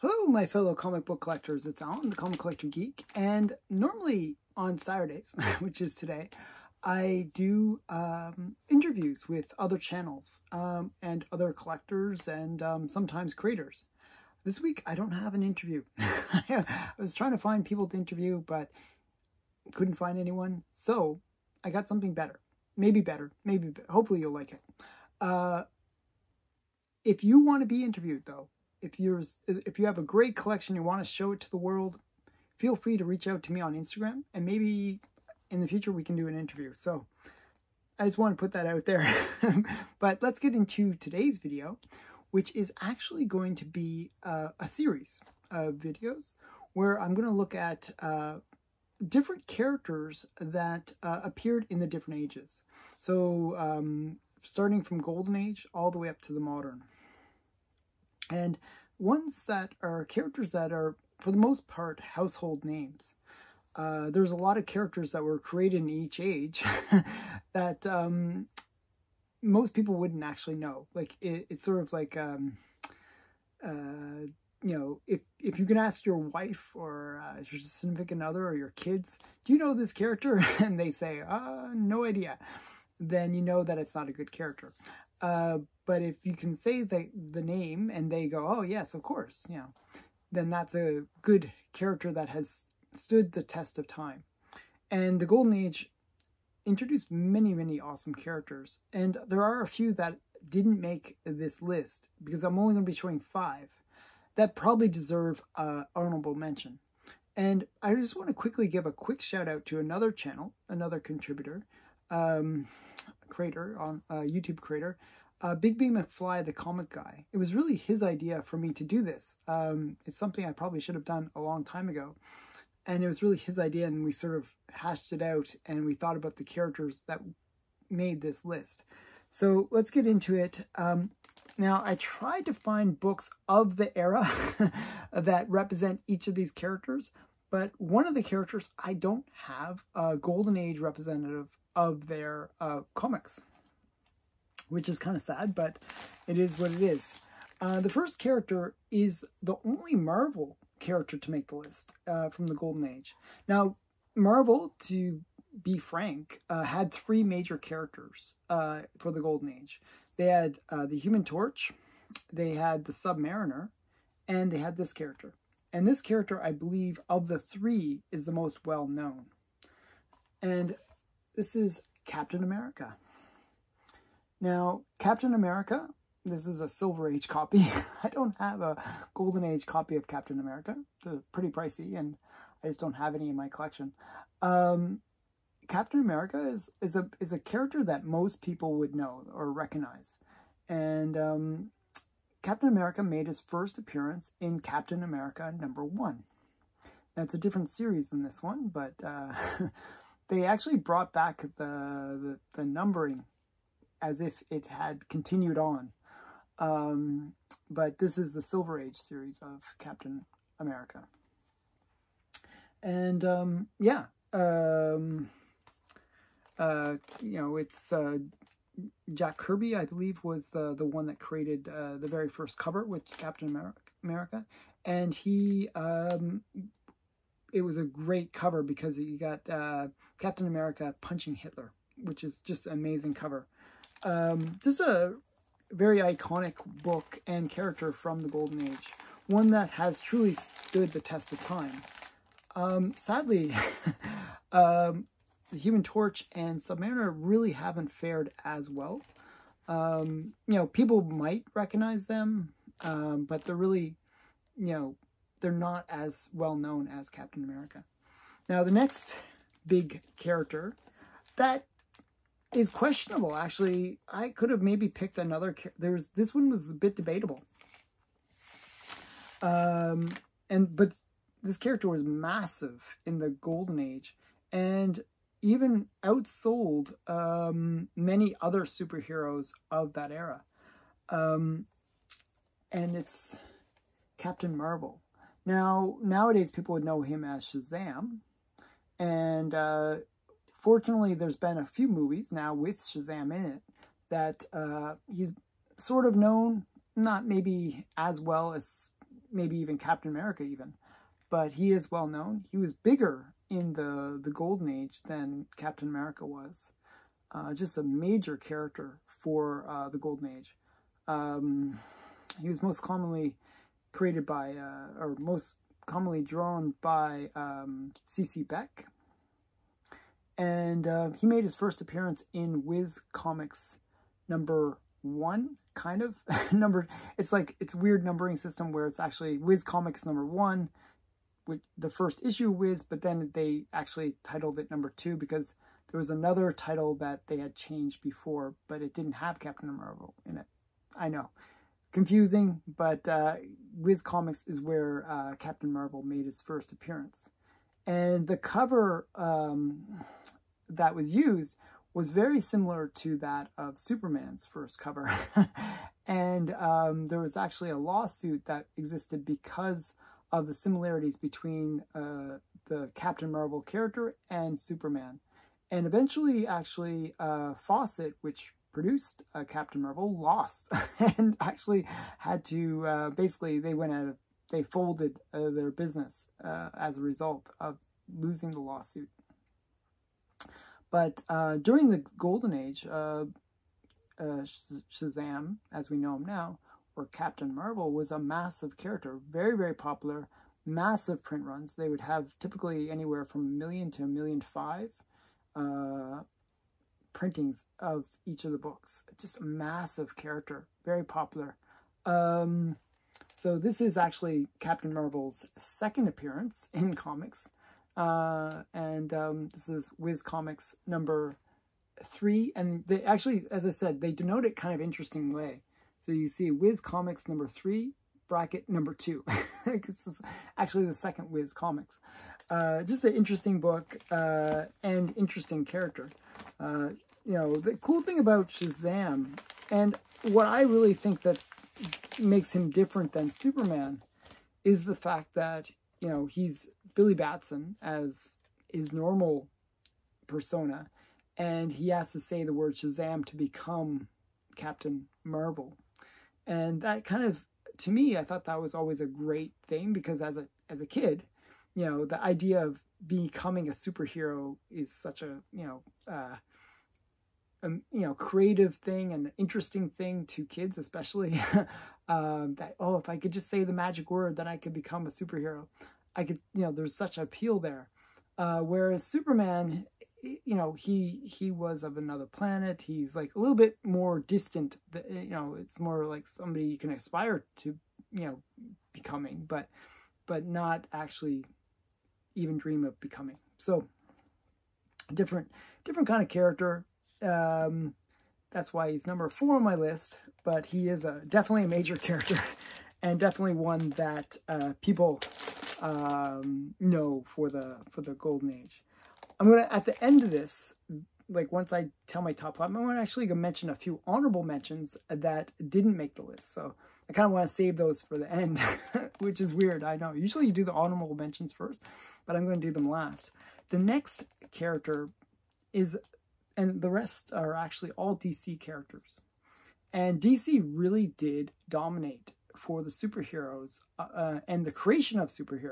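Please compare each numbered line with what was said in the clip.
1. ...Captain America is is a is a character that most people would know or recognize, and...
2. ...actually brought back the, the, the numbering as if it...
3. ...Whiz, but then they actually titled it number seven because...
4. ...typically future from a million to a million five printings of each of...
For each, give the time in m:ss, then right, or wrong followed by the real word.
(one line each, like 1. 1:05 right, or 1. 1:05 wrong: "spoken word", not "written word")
1. 3:05 right
2. 3:20 right
3. 5:32 wrong: "two", not "seven"
4. 6:32 wrong: "anywhere", not "future".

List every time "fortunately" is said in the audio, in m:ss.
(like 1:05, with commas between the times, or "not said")
4:50.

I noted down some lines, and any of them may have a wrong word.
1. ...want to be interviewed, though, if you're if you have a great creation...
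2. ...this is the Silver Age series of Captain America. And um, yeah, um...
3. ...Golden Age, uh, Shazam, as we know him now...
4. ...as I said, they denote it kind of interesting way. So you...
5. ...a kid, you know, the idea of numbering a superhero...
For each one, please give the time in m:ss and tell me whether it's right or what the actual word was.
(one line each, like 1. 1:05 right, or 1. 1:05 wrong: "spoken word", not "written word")
1. 0:27 wrong: "collection", not "creation"
2. 3:27 right
3. 6:22 right
4. 6:53 right
5. 7:30 wrong: "becoming", not "numbering".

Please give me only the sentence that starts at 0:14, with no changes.
This week, I don't have an interview.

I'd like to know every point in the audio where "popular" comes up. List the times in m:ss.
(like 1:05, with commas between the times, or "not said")
6:29, 6:41.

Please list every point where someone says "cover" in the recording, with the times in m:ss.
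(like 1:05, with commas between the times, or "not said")
3:42, 3:48, 3:53, 5:48, 5:54.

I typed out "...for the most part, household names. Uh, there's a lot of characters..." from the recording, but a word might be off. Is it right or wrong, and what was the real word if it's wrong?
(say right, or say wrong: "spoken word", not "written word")
right.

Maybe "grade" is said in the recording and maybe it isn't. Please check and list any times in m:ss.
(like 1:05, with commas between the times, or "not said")
not said.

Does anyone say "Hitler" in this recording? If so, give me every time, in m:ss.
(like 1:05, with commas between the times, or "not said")
3:51.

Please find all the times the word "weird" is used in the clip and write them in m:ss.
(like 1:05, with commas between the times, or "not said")
5:27, 8:29.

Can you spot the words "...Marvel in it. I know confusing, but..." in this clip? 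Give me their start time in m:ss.
5:39.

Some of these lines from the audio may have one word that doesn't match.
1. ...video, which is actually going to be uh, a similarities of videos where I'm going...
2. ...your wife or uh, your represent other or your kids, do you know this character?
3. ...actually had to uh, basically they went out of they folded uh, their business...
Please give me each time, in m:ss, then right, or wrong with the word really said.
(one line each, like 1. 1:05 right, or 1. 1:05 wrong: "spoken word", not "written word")
1. 0:41 wrong: "series", not "similarities"
2. 1:16 wrong: "significant", not "represent"
3. 6:11 right.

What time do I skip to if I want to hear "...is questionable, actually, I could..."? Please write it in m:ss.
4:22.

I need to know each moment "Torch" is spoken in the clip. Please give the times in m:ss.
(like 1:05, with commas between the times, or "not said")
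2:41, 4:05.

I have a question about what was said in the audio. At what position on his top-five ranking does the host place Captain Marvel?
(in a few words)
number 4.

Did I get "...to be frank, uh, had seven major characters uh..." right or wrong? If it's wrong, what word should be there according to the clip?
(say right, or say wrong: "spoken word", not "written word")
wrong: "three", not "seven".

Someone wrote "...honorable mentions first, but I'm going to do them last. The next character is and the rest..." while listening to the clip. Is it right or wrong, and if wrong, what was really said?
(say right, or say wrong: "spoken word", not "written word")
right.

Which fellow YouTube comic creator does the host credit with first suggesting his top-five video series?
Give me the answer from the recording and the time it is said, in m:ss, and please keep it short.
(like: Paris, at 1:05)
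Big B McFly, at 1:55.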